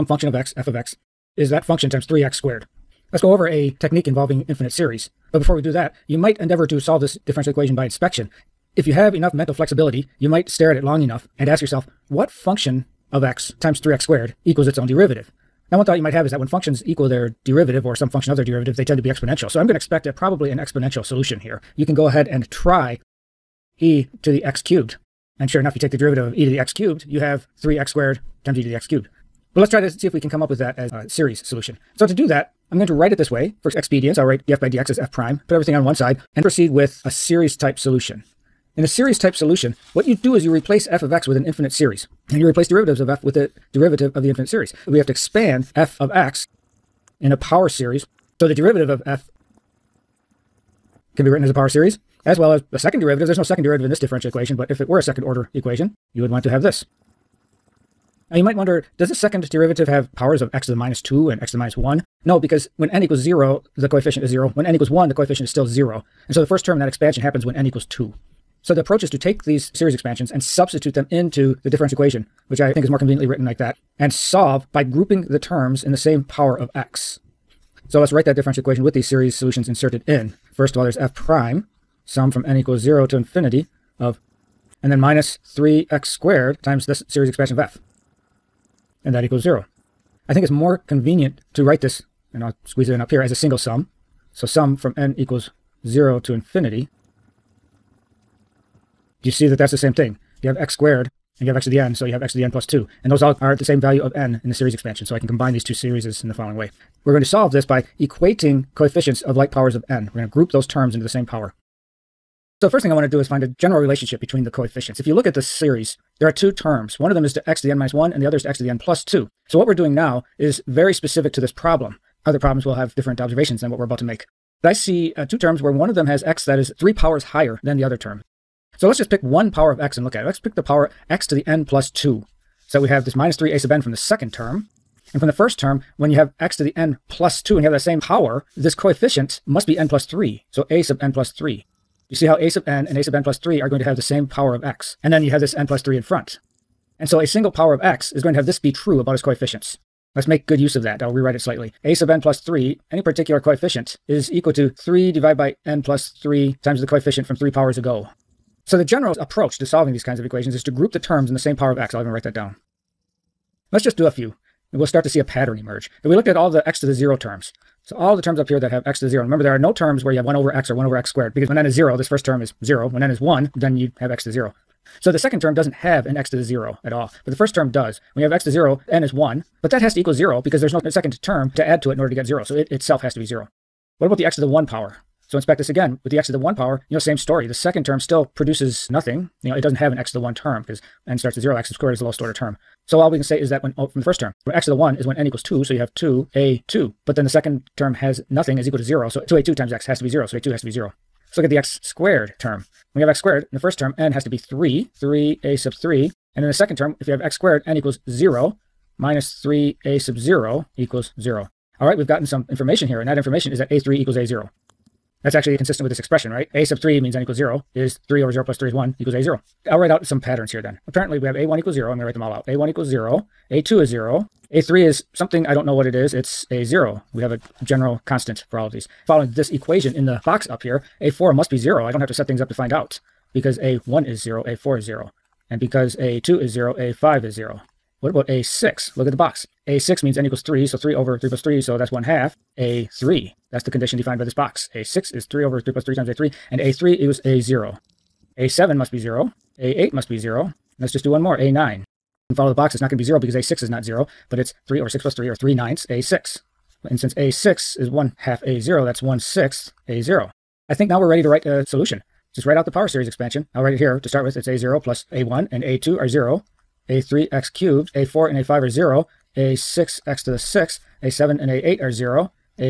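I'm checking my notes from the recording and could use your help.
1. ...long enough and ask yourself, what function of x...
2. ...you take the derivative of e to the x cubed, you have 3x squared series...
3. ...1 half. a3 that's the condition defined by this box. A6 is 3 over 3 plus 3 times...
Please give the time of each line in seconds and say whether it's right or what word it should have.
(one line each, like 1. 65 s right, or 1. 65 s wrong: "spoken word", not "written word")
1. 10 s right
2. 25 s wrong: "times", not "series"
3. 241 s right.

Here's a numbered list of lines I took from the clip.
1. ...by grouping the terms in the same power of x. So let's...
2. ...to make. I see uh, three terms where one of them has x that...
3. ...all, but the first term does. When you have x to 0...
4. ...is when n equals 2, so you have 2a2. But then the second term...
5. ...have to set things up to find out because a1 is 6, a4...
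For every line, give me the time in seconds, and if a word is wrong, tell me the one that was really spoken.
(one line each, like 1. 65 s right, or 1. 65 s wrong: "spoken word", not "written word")
1. 74 s right
2. 123 s wrong: "two", not "three"
3. 176 s right
4. 194 s right
5. 232 s wrong: "0", not "6".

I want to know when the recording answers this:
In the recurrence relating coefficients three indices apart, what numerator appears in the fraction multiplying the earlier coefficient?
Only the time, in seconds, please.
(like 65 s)
154 s.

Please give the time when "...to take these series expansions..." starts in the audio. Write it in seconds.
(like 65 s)
69 s.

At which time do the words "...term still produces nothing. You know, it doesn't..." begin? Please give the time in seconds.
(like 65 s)
187 s.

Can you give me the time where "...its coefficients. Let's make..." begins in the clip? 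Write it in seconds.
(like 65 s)
149 s.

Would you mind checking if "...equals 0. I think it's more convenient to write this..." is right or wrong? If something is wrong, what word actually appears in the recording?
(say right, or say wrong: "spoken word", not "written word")
right.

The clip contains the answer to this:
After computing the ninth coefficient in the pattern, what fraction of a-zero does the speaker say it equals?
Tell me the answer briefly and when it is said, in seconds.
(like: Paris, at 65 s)
1/6, at 259 s.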